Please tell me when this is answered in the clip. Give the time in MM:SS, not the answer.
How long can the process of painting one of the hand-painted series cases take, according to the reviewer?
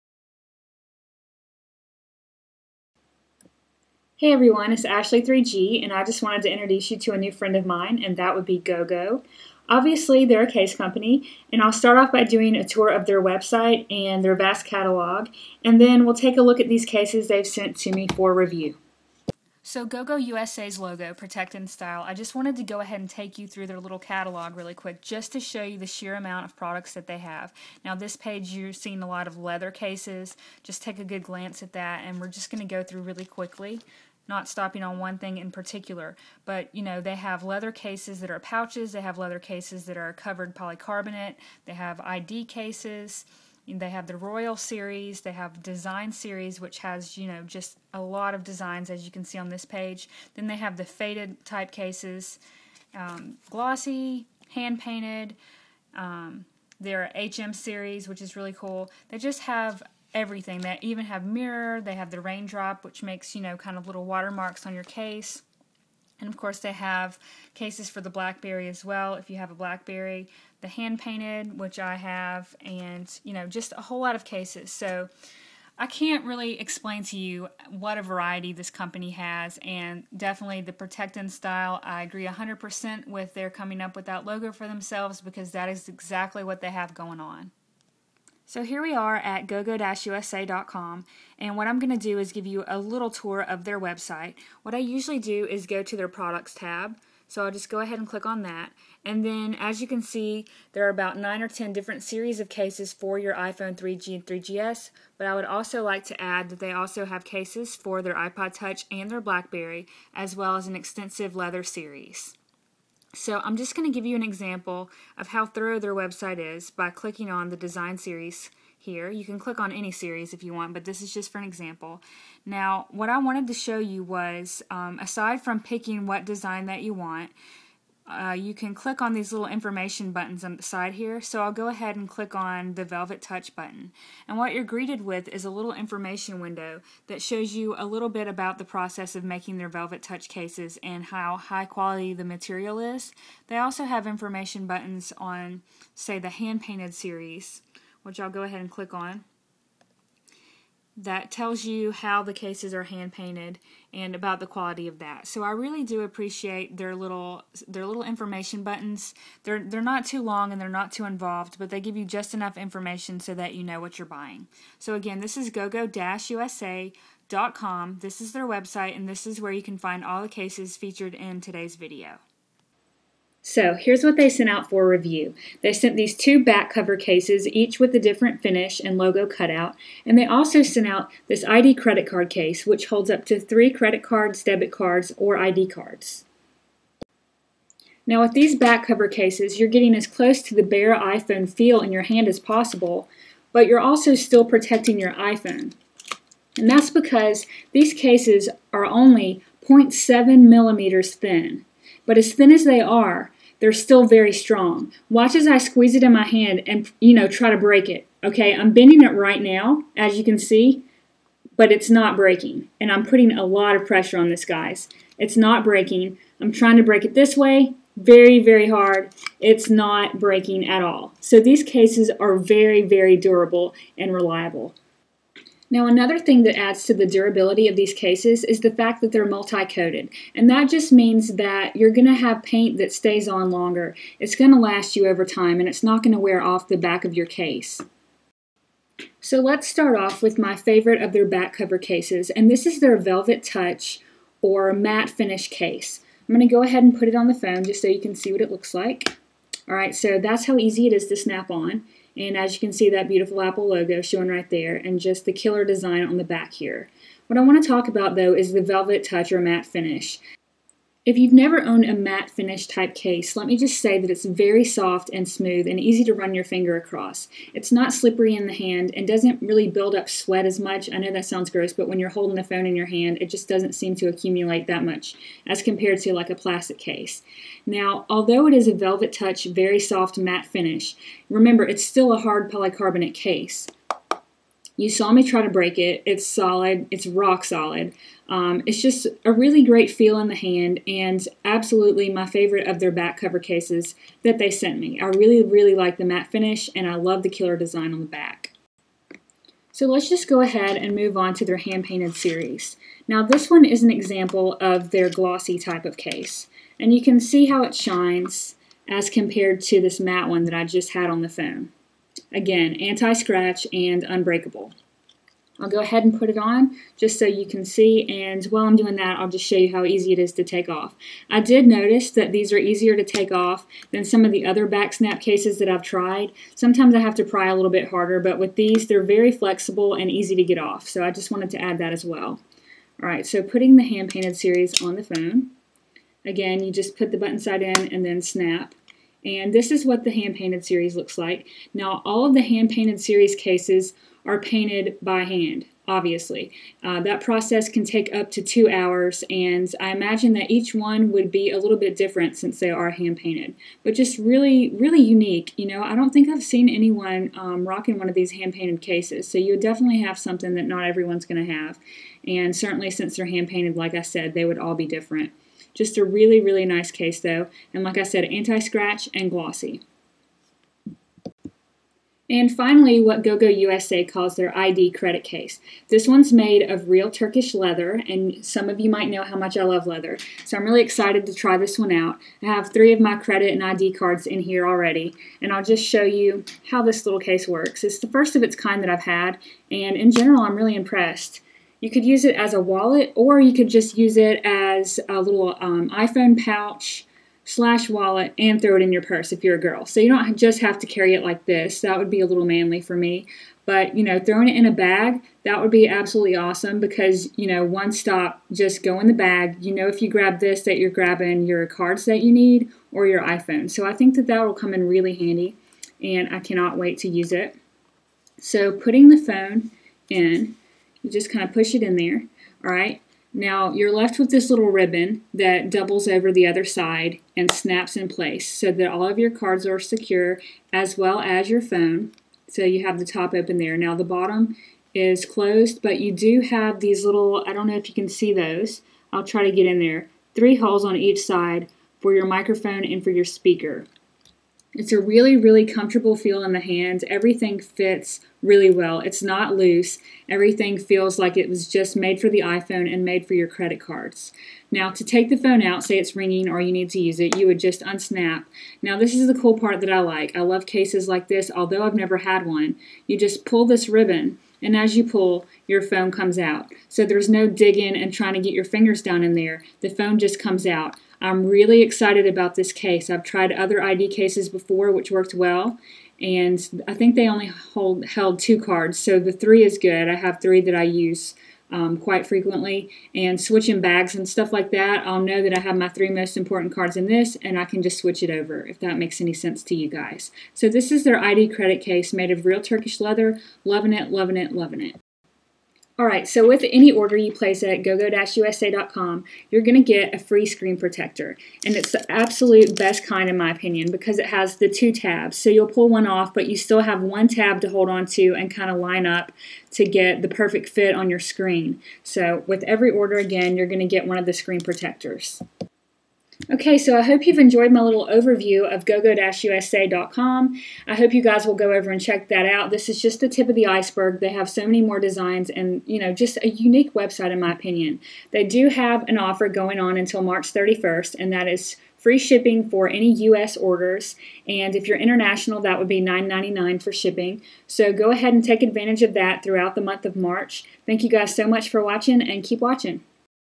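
05:48.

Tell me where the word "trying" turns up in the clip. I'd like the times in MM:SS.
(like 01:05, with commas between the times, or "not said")
03:36, 07:48.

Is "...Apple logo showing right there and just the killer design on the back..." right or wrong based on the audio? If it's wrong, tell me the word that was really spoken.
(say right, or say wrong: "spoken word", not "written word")
right.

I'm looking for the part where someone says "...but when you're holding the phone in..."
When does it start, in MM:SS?
04:31.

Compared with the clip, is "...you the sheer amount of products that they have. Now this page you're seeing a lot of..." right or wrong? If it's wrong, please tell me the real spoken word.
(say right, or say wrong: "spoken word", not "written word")
right.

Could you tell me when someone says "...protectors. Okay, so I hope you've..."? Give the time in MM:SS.
08:34.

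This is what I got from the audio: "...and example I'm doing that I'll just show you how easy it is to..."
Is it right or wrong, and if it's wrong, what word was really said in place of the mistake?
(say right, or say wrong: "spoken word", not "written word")
wrong: "while", not "example".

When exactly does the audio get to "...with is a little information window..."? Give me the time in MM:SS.
02:15.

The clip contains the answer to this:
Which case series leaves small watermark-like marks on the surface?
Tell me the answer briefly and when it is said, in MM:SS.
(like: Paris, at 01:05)
raindrop, at 01:02.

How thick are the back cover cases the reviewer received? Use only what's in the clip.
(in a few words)
0.7 millimeters.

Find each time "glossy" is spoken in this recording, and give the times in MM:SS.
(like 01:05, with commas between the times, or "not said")
00:53, 05:05, 06:09.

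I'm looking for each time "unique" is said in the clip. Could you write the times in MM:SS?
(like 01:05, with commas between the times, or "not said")
05:55, 08:46.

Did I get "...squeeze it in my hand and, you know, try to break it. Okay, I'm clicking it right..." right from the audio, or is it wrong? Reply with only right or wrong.
wrong.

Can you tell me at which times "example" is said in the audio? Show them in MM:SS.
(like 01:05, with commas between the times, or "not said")
01:54, 02:01, 05:03.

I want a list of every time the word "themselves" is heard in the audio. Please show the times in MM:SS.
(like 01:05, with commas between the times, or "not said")
01:24.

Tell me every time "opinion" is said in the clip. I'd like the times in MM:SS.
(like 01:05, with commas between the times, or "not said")
08:23, 08:47.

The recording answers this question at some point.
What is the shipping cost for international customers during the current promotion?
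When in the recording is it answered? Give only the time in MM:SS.
08:56.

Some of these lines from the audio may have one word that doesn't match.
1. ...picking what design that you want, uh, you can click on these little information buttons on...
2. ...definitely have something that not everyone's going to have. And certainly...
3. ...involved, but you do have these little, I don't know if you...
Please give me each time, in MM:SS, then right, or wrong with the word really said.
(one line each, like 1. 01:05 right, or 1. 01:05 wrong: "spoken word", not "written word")
1. 02:05 right
2. 05:59 right
3. 07:15 wrong: "closed", not "involved".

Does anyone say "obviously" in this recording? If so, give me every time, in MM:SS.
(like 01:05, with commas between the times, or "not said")
00:09, 05:45.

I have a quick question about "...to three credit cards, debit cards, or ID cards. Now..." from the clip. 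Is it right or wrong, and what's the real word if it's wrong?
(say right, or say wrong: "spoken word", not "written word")
right.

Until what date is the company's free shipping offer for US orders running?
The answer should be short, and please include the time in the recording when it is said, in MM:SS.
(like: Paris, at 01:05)
March 31st, at 08:50.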